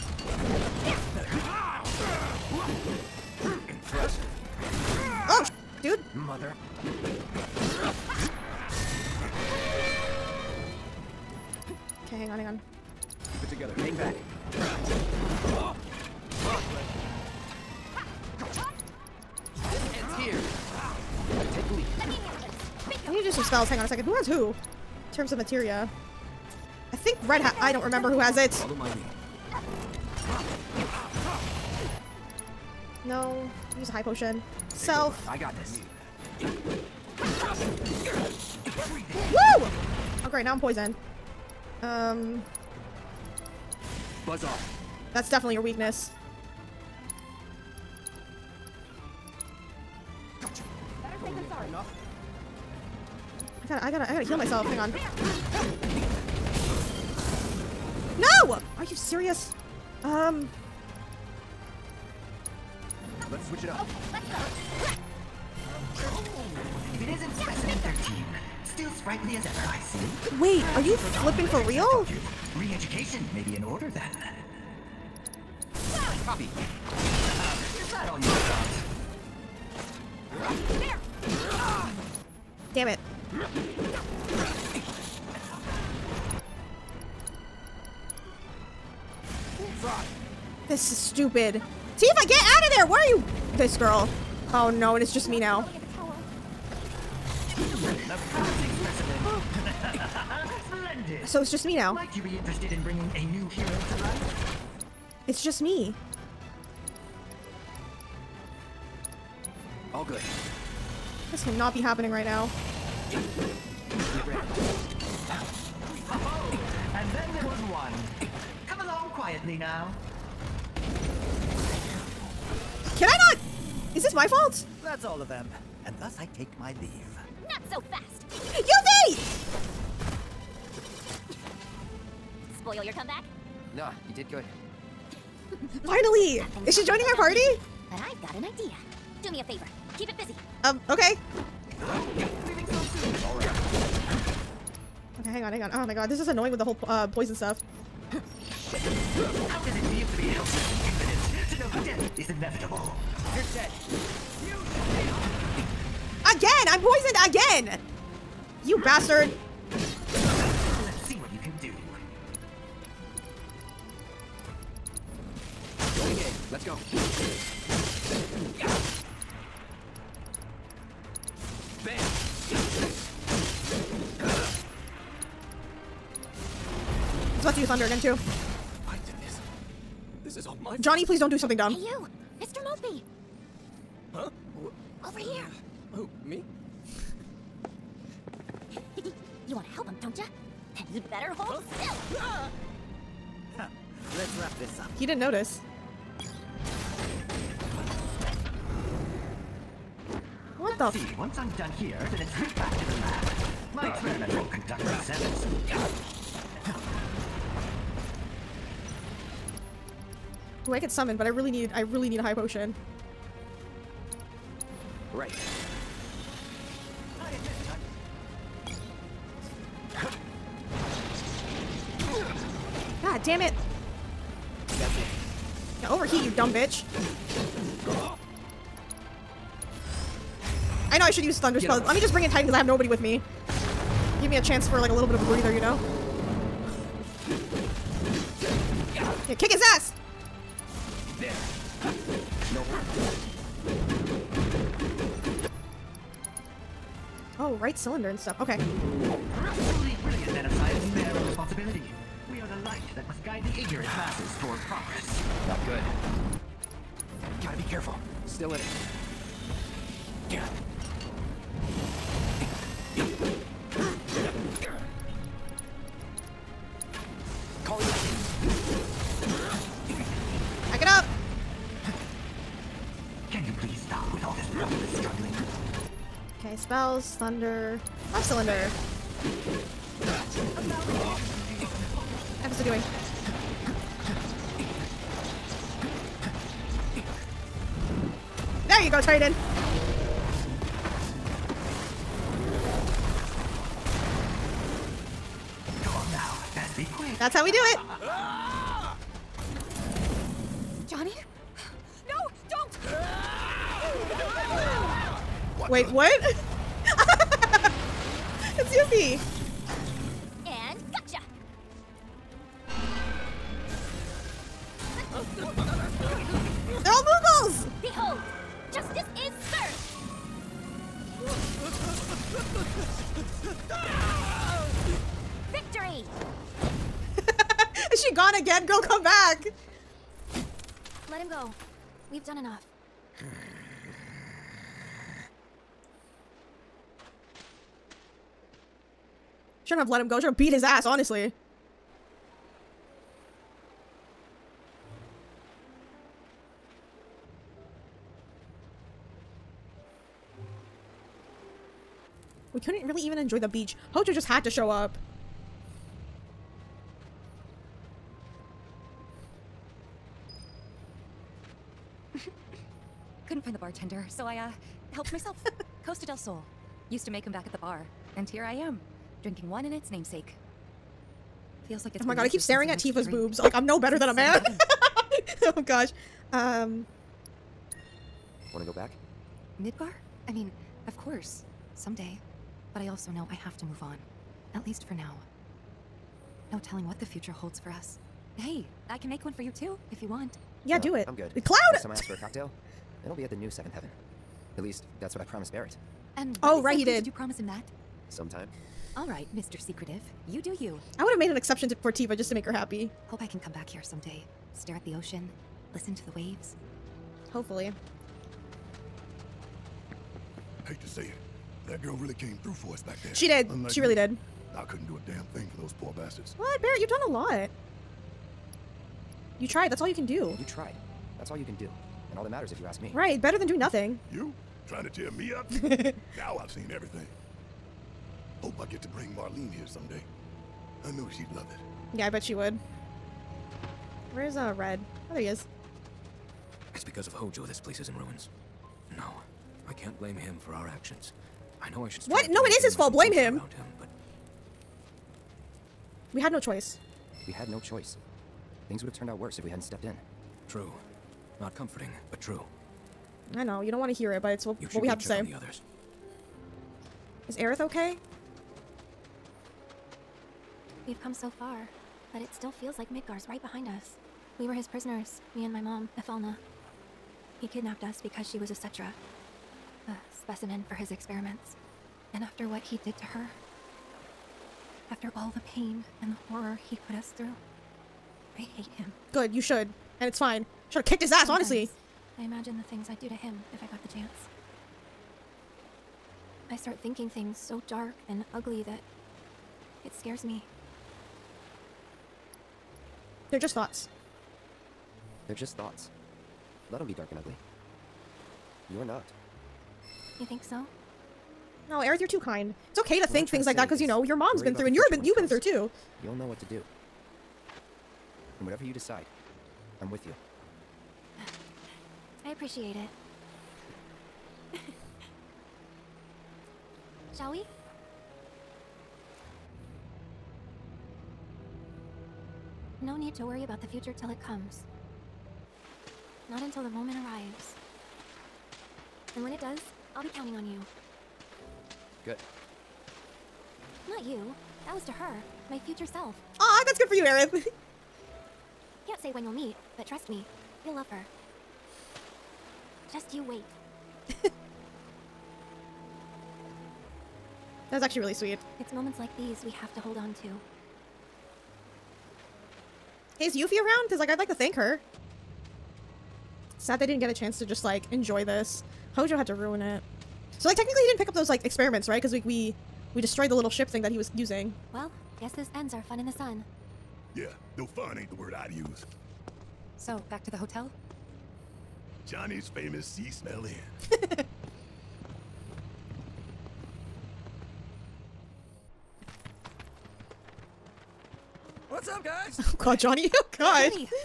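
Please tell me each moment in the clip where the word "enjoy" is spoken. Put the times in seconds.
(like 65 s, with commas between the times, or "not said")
353 s, 557 s.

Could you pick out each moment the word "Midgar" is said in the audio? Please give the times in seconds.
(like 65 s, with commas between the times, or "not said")
379 s, 462 s.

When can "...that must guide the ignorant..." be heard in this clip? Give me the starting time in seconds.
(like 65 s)
252 s.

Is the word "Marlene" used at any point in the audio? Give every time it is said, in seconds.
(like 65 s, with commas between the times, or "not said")
429 s.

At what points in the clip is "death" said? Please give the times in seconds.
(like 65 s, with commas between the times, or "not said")
151 s.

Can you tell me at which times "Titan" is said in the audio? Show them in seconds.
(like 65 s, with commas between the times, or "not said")
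232 s, 289 s.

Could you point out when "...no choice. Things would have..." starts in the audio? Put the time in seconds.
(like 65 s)
447 s.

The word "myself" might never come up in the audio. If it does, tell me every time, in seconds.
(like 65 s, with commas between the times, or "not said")
54 s, 365 s.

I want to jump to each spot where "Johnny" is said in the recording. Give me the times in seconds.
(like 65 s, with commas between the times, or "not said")
180 s, 300 s, 572 s, 582 s.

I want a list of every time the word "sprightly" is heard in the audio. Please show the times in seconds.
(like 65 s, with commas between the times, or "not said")
68 s.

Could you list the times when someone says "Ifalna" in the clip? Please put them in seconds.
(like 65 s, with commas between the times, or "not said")
465 s.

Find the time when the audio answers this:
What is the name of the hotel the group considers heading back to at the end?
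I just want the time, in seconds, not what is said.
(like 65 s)
572 s.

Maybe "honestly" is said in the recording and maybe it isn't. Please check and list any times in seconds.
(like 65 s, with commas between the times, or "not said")
340 s, 481 s.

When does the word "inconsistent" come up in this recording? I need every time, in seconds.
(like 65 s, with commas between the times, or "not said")
not said.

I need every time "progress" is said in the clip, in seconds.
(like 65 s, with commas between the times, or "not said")
254 s.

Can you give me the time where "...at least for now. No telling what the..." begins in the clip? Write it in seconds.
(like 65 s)
384 s.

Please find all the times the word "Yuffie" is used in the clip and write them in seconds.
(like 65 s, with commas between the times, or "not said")
308 s, 553 s.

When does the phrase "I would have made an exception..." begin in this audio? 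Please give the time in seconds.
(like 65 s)
400 s.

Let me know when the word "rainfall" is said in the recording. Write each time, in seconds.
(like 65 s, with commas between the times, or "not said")
not said.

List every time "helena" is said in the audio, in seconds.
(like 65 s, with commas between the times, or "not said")
not said.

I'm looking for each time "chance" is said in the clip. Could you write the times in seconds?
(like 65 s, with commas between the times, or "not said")
234 s, 483 s, 557 s.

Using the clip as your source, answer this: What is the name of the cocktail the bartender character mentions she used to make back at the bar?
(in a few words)
Costa del Sol.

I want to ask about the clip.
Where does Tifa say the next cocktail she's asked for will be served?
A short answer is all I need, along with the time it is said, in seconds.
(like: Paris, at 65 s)
the new Seventh Heaven, at 393 s.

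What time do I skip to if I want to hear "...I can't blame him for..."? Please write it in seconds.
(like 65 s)
439 s.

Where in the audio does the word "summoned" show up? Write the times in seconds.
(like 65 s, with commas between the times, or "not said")
210 s.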